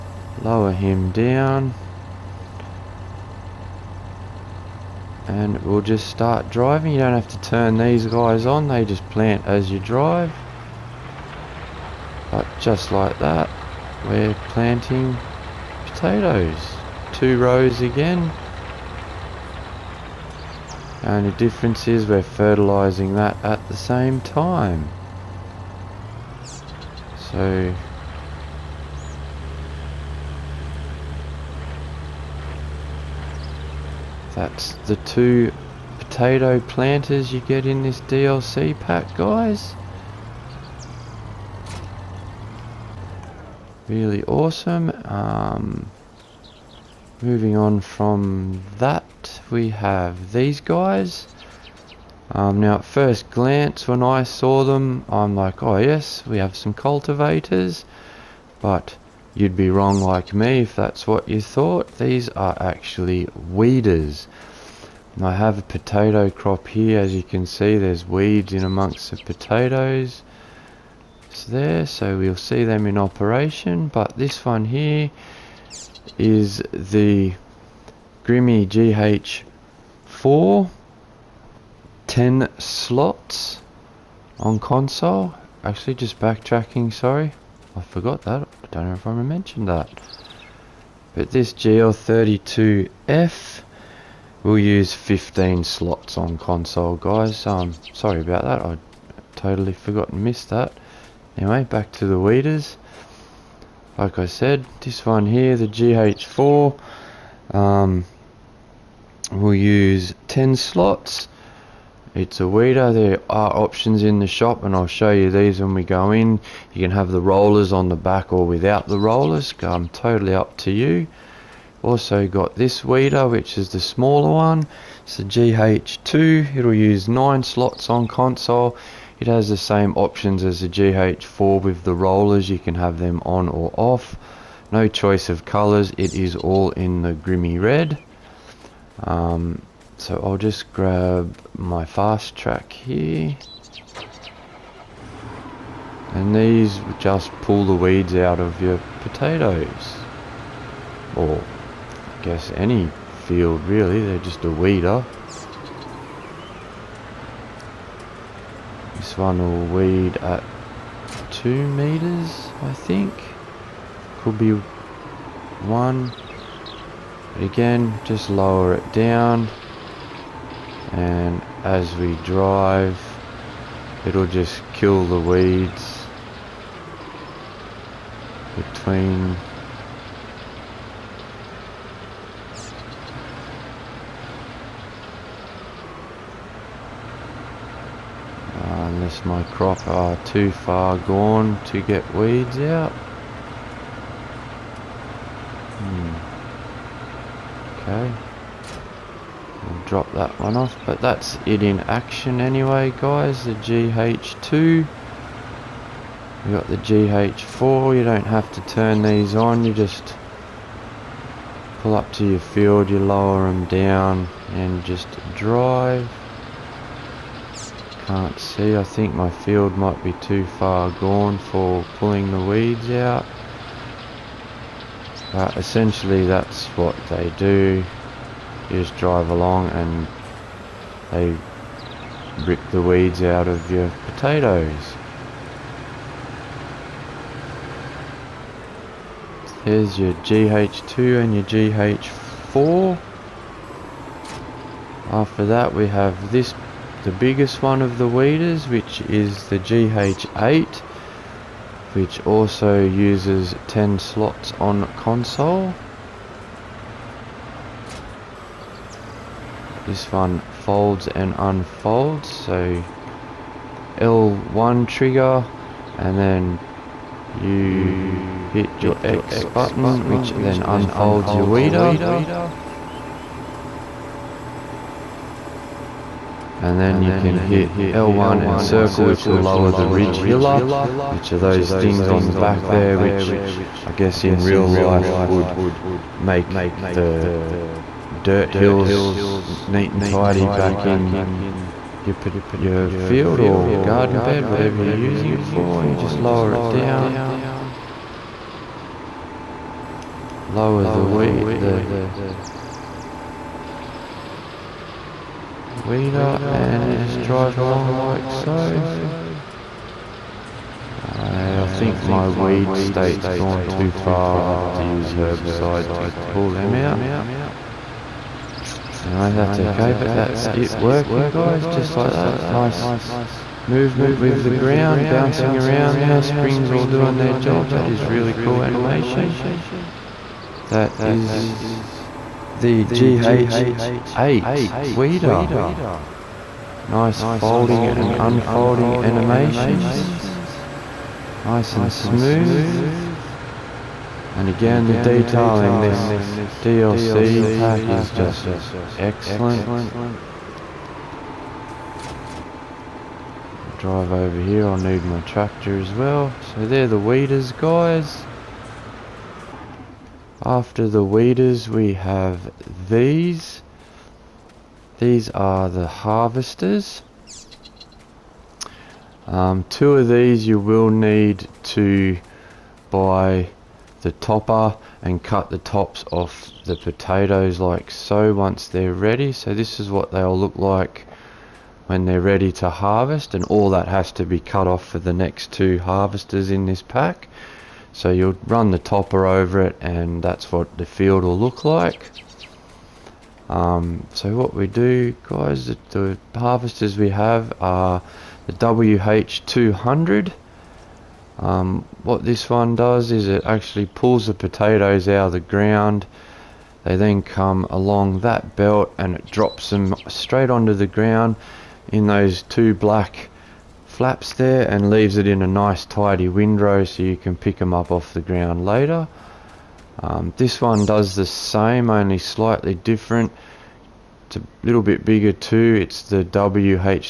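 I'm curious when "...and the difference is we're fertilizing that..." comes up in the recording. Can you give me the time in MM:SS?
00:21.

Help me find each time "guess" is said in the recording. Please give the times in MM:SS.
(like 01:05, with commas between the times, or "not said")
02:32, 04:43.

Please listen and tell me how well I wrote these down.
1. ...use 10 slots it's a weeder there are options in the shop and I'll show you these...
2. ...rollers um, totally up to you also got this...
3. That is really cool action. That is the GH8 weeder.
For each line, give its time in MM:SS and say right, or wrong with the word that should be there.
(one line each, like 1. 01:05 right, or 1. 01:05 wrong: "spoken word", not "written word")
1. 01:49 right
2. 01:58 right
3. 05:27 wrong: "animation", not "action".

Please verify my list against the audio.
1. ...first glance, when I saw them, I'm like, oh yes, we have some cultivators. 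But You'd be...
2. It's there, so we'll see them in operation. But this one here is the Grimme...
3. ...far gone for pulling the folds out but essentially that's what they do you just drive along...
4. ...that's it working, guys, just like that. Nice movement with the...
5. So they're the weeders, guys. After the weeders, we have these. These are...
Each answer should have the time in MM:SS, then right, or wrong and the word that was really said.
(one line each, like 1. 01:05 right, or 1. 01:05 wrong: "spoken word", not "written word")
1. 00:52 right
2. 01:11 right
3. 03:40 wrong: "weeds", not "folds"
4. 05:20 right
5. 05:56 right.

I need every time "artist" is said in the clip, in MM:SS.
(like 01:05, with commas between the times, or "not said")
not said.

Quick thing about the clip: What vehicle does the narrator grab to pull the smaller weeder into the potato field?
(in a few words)
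Fast track.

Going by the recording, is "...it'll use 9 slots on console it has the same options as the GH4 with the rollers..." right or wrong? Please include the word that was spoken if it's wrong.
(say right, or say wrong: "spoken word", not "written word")
right.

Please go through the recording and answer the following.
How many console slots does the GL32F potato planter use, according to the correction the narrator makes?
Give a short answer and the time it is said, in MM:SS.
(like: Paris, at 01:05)
15, at 01:34.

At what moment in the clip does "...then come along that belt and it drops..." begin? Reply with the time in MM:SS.
06:46.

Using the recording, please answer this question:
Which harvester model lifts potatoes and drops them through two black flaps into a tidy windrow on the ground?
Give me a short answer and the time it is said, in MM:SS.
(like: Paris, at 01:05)
WH200, at 06:38.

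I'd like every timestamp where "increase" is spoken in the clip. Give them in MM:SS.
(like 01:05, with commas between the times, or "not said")
not said.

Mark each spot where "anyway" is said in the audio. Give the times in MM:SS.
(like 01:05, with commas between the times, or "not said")
01:41, 03:22.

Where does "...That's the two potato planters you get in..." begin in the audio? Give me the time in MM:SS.
00:34.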